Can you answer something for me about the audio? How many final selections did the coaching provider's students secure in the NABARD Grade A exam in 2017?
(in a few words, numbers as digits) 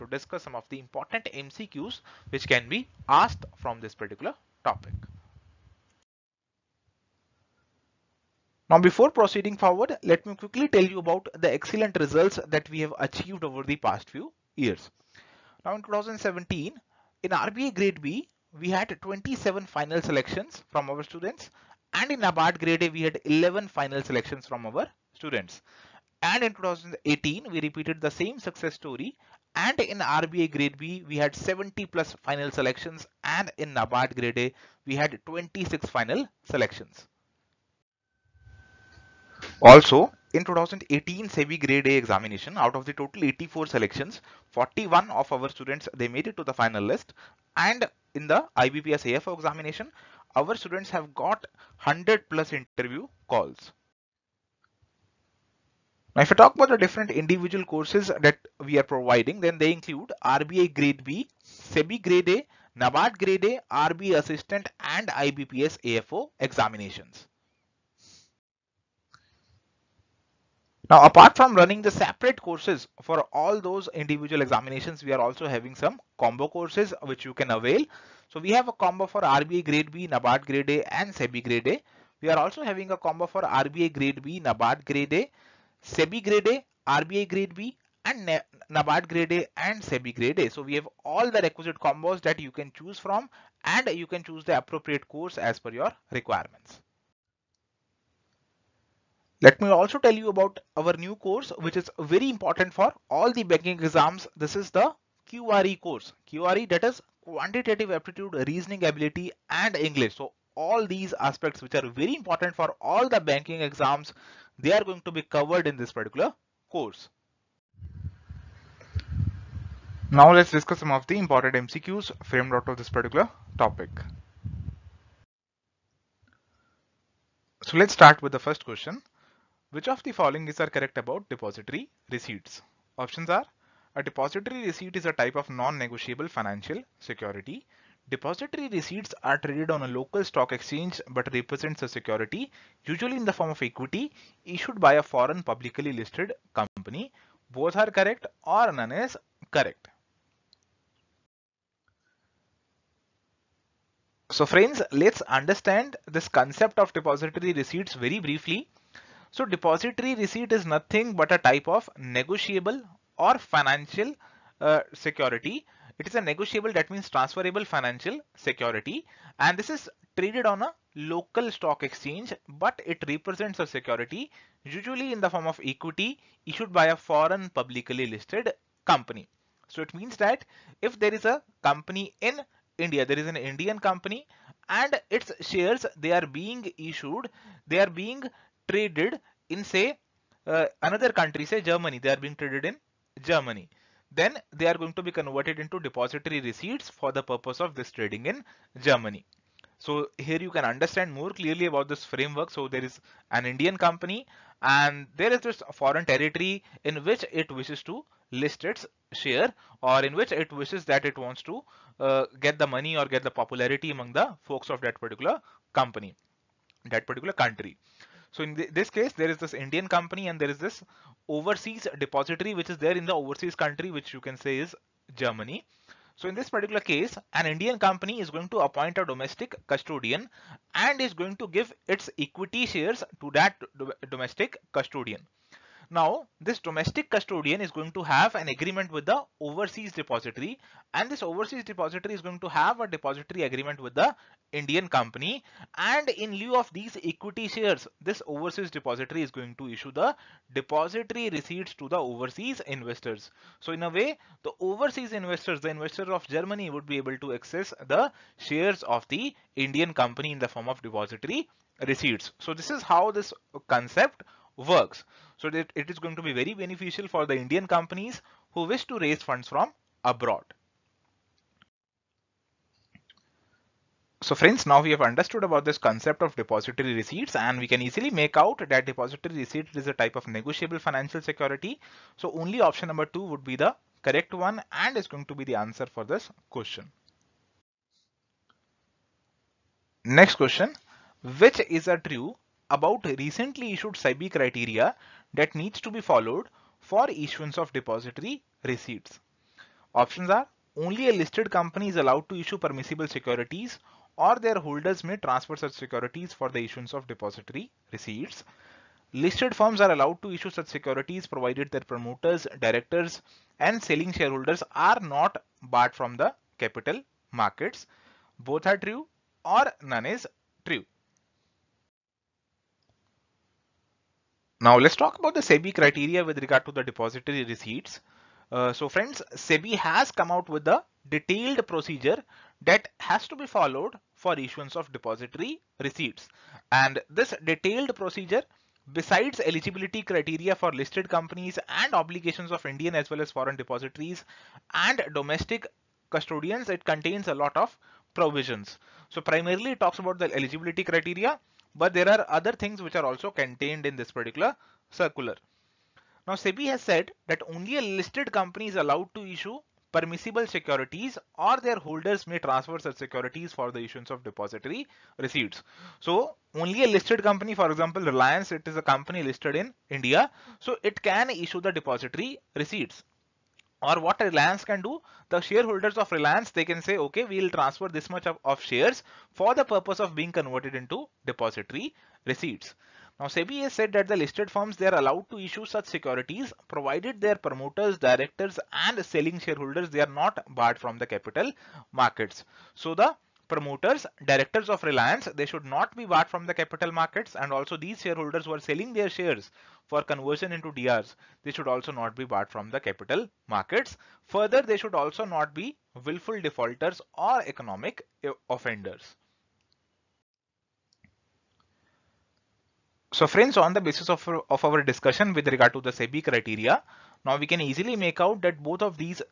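11.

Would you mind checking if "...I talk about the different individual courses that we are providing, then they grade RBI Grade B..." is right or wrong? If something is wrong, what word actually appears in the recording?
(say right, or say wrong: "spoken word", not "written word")
wrong: "include", not "grade".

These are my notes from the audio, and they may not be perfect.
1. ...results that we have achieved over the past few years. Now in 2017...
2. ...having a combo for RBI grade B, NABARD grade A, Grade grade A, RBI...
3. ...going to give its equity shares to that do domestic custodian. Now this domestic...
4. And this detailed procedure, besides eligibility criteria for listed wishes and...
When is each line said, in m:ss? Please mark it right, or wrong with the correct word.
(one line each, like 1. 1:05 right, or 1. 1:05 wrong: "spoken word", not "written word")
1. 0:11 right
2. 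1:22 wrong: "SEBI", not "Grade"
3. 3:51 right
4. 5:36 wrong: "companies", not "wishes".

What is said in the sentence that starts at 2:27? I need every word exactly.
Both are correct or none is correct.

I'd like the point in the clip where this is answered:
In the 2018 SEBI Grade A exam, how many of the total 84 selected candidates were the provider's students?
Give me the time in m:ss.
0:44.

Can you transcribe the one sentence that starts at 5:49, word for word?
So primarily it talks about the eligibility criteria but there are other things which are also contained in this particular circular.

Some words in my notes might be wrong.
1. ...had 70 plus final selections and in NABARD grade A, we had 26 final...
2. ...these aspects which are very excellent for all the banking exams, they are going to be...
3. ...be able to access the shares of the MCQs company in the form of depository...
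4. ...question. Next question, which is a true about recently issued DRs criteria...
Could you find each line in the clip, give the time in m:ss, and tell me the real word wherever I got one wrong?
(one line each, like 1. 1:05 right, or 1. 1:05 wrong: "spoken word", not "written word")
1. 0:31 right
2. 1:50 wrong: "important", not "excellent"
3. 4:16 wrong: "Indian", not "MCQs"
4. 4:46 wrong: "SEBI", not "DRs".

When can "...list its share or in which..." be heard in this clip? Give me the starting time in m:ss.
3:28.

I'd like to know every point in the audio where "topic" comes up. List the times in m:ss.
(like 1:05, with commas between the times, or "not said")
0:04, 2:03.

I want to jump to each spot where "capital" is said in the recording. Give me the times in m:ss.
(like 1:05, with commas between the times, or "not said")
5:16, 6:31, 6:36, 6:42.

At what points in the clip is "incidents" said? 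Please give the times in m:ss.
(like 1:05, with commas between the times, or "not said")
not said.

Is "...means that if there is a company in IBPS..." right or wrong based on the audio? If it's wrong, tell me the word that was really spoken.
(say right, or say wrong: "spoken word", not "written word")
wrong: "India", not "IBPS".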